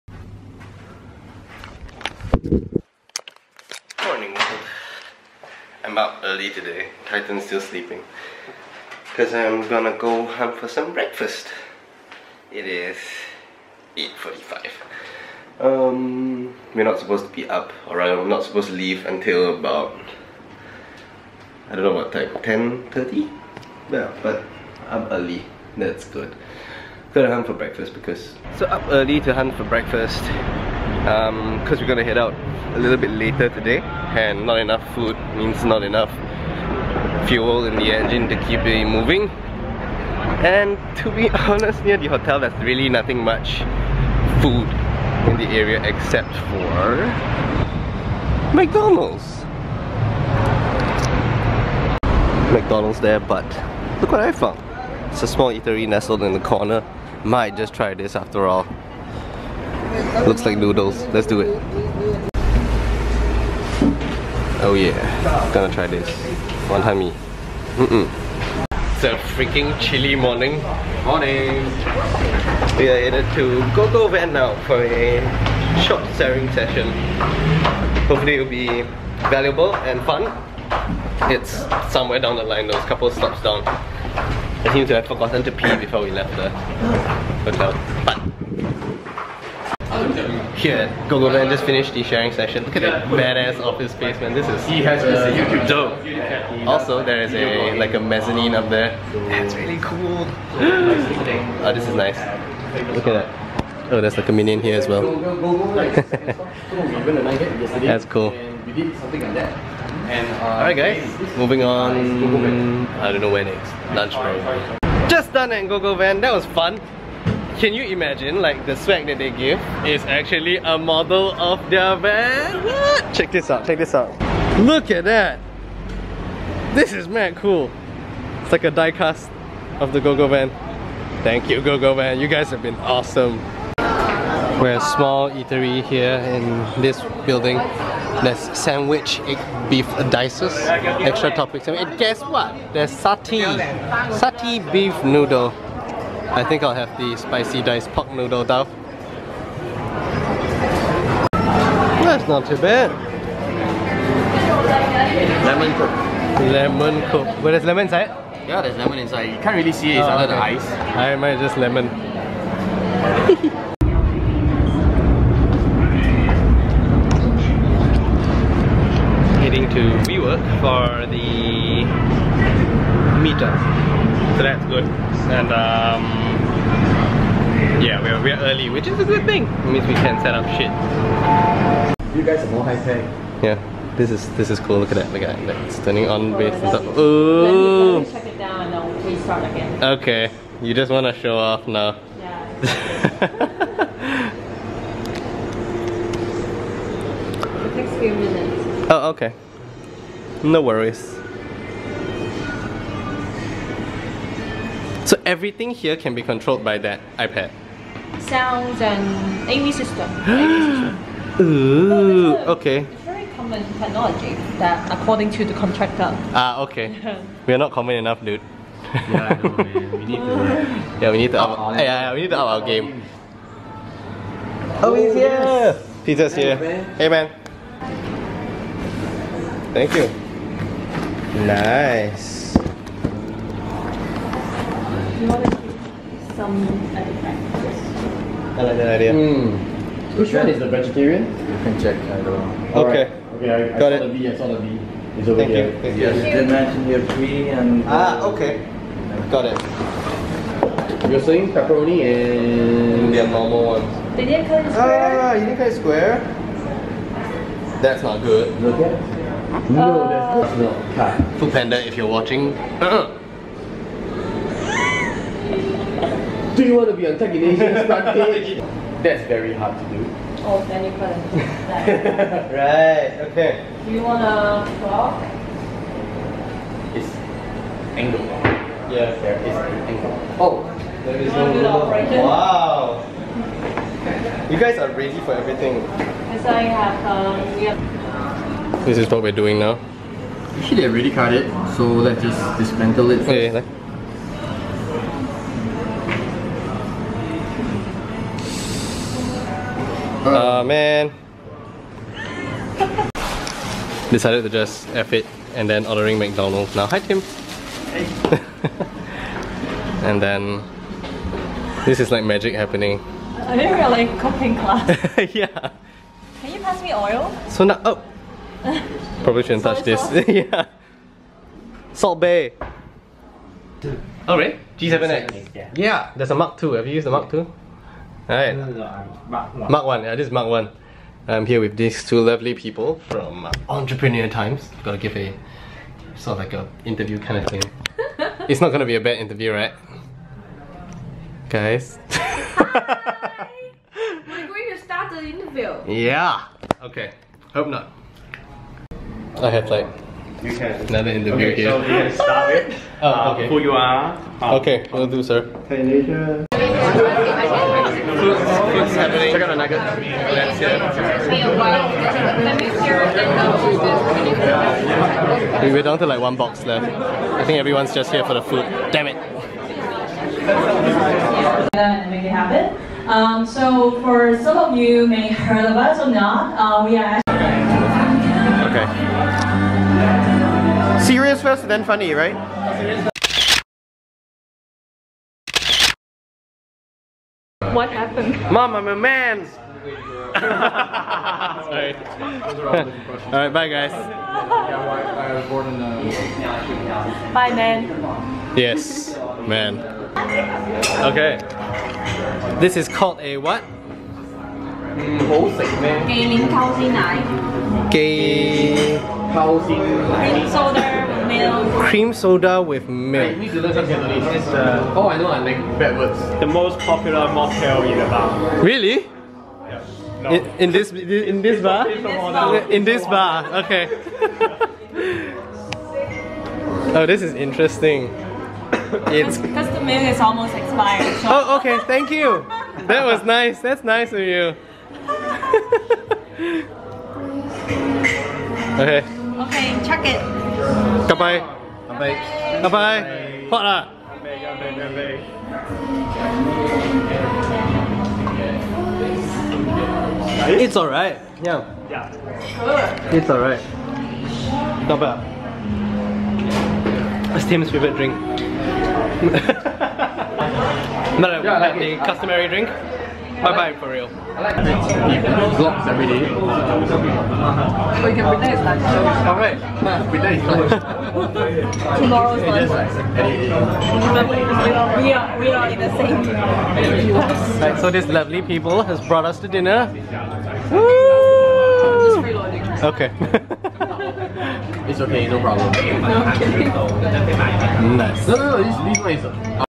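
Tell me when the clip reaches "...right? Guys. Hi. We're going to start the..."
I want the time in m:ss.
5:39.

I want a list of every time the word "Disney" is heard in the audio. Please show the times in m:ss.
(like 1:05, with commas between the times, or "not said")
not said.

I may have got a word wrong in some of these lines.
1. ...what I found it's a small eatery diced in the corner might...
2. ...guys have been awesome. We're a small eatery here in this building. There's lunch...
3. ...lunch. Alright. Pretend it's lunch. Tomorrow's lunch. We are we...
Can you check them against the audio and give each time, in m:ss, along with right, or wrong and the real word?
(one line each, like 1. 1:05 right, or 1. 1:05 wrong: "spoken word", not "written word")
1. 0:54 wrong: "nestled", not "diced"
2. 2:12 wrong: "sandwich", not "lunch"
3. 7:48 right.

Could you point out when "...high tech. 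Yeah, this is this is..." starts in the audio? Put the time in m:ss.
3:02.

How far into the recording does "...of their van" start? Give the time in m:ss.
2:01.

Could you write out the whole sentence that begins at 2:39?
You can't really see it, it's oh, under okay.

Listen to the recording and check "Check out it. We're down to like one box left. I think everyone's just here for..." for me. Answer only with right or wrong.
right.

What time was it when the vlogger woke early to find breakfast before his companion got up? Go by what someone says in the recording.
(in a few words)
8:45.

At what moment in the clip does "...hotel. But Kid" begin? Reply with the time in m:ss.
1:27.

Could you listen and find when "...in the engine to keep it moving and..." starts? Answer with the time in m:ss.
0:37.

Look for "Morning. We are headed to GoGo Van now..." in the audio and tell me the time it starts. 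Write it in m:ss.
1:11.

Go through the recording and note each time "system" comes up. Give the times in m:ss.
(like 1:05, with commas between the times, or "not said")
3:29.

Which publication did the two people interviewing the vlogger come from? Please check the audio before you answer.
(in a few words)
Entrepreneur Times.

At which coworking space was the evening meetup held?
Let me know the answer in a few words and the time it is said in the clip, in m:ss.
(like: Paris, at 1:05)
WeWork, at 2:50.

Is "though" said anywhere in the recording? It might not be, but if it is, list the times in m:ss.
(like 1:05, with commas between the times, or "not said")
2:28.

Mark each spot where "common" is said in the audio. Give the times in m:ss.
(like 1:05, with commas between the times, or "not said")
3:33, 3:37.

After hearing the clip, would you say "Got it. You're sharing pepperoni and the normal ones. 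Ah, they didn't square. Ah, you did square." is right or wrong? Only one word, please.
wrong.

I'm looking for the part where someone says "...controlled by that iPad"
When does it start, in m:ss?
3:26.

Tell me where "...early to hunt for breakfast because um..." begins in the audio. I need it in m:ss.
0:28.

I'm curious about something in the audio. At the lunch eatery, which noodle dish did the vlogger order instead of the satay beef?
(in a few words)
Spicy diced pork noodle.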